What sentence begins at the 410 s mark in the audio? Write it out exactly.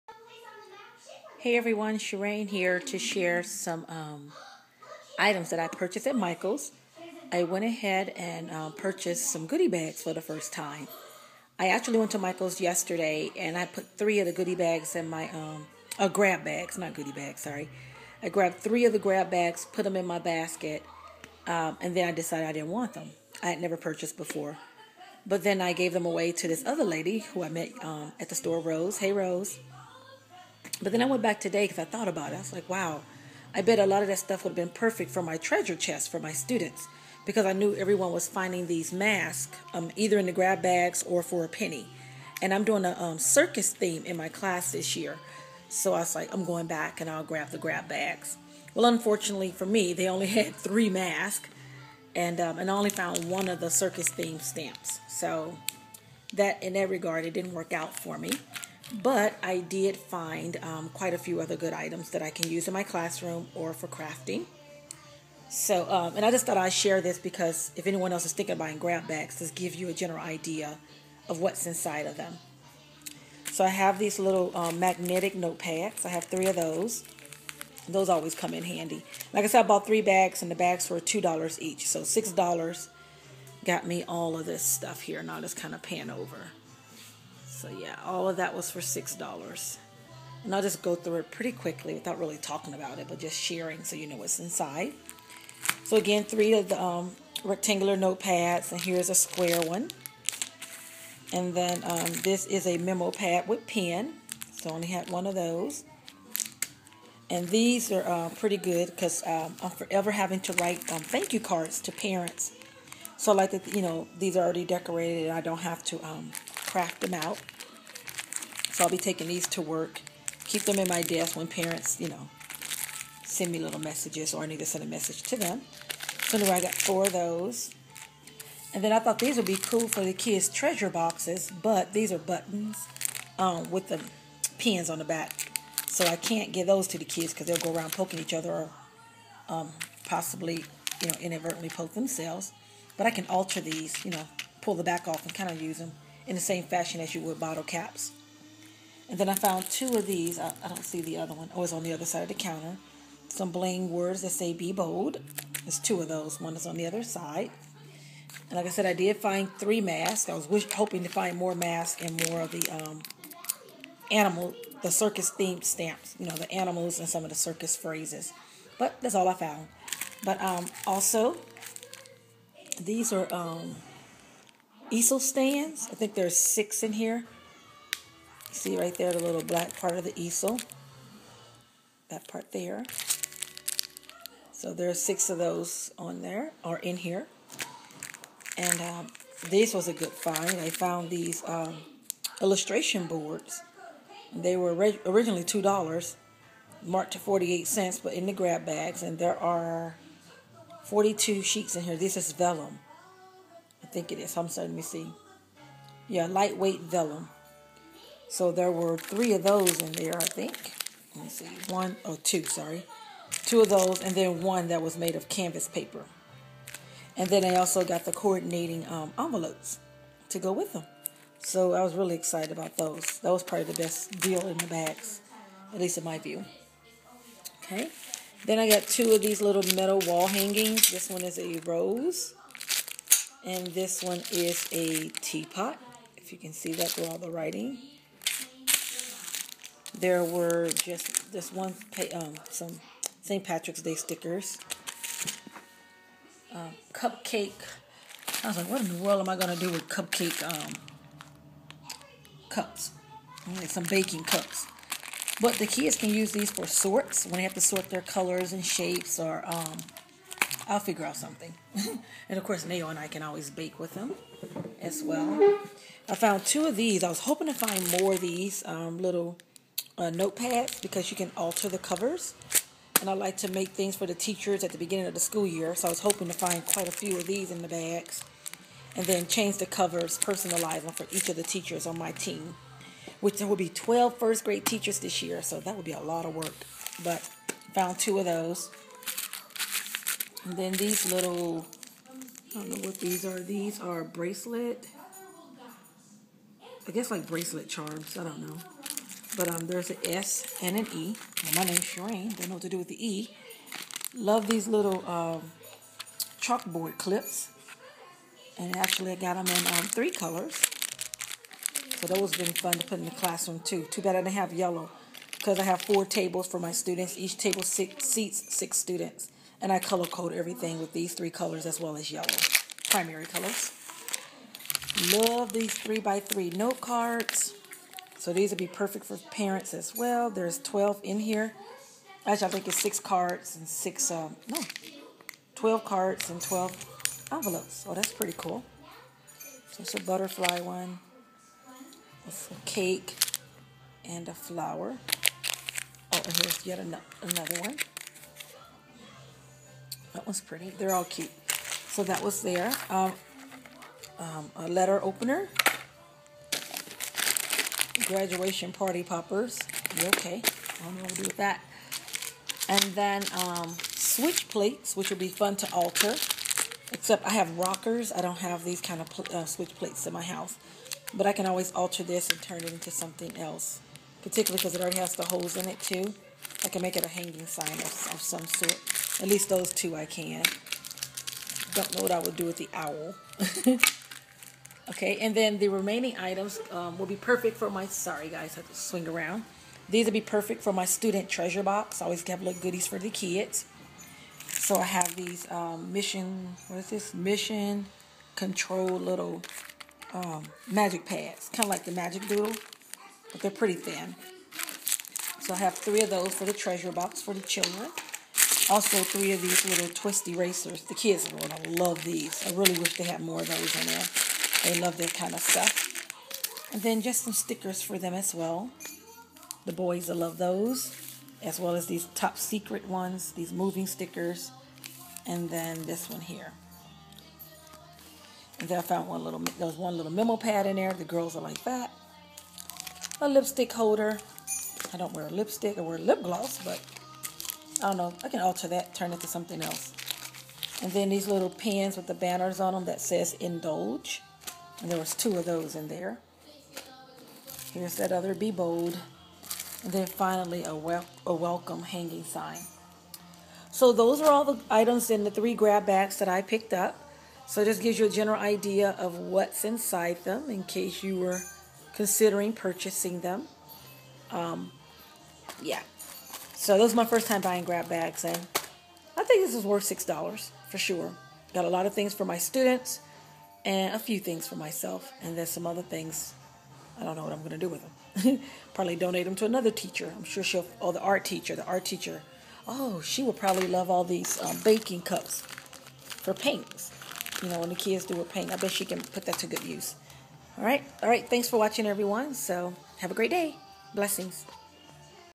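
The kids are going to love these.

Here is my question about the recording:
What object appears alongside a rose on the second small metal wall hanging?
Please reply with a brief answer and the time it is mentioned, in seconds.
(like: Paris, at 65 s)
teapot, at 235 s.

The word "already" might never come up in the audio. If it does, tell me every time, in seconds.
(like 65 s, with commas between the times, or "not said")
114 s, 374 s.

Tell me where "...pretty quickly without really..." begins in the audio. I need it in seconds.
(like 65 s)
91 s.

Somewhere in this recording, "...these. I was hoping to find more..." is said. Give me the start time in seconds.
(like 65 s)
266 s.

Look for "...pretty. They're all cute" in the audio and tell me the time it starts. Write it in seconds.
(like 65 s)
350 s.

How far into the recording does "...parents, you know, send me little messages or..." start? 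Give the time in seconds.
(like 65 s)
121 s.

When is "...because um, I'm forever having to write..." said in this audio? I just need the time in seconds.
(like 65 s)
108 s.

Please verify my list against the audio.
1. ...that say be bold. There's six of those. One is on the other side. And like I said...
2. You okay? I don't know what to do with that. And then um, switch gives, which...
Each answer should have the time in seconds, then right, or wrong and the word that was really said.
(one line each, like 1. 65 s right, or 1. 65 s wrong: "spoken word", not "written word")
1. 154 s wrong: "two", not "six"
2. 359 s wrong: "plates", not "gives".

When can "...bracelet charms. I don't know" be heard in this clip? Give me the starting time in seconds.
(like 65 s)
297 s.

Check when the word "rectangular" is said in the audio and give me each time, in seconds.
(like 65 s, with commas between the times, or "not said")
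97 s.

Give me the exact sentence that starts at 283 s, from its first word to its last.
Which there will be 12 first grade teachers this year.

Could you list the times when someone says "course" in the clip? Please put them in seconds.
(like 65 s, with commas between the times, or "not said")
262 s.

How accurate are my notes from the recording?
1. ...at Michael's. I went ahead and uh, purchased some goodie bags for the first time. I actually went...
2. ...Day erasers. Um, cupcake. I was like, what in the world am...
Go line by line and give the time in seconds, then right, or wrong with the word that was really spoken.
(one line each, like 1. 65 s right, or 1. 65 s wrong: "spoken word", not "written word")
1. 6 s right
2. 243 s wrong: "stickers", not "erasers".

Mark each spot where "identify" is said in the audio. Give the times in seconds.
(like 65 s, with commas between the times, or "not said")
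not said.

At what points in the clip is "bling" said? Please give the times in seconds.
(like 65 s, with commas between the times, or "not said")
153 s.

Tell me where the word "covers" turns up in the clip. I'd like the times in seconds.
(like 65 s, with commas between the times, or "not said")
271 s, 279 s.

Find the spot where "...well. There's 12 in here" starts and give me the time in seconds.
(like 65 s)
329 s.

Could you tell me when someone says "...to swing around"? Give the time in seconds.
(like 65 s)
388 s.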